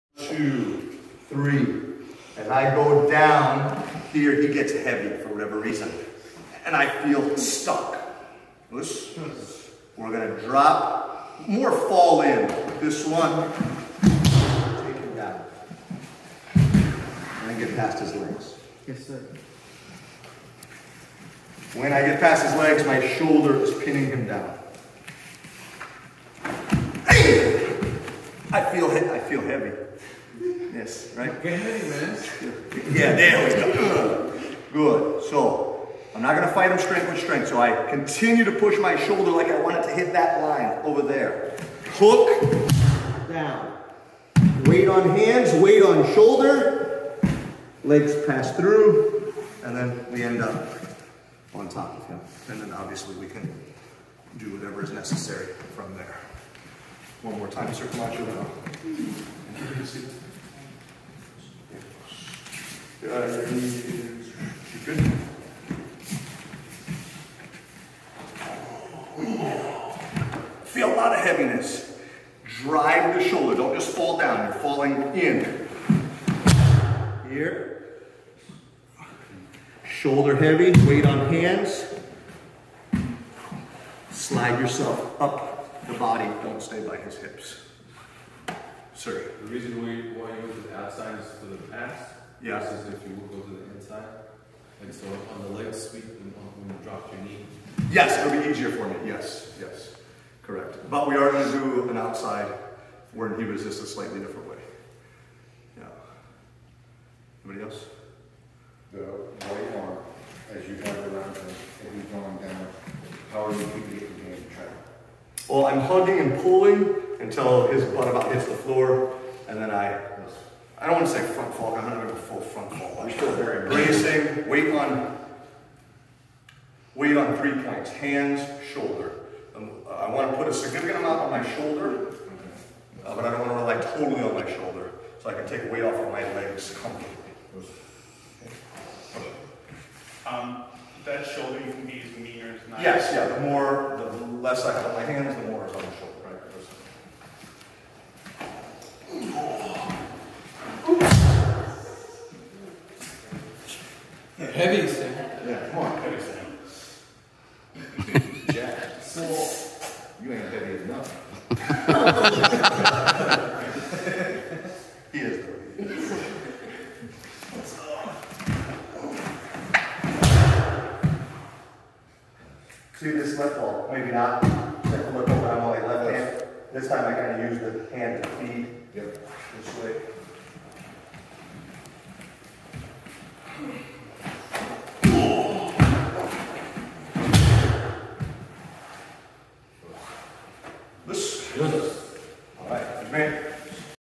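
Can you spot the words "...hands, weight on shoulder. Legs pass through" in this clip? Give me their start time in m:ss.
0:45.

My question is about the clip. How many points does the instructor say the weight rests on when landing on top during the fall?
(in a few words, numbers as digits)
3.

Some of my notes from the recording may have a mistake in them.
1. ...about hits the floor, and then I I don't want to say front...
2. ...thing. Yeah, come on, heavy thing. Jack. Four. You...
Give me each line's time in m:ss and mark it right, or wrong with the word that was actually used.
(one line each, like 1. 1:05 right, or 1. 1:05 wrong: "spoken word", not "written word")
1. 1:58 right
2. 2:34 right.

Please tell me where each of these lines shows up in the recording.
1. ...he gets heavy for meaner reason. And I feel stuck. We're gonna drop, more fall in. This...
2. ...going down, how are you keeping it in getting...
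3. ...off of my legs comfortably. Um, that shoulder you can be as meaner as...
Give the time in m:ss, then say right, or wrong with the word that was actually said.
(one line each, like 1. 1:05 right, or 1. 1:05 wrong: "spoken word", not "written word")
1. 0:04 wrong: "whatever", not "meaner"
2. 1:52 right
3. 2:15 right.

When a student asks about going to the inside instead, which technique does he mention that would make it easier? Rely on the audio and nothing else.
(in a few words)
Leg sweep.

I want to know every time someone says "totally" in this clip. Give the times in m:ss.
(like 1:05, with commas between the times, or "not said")
2:13.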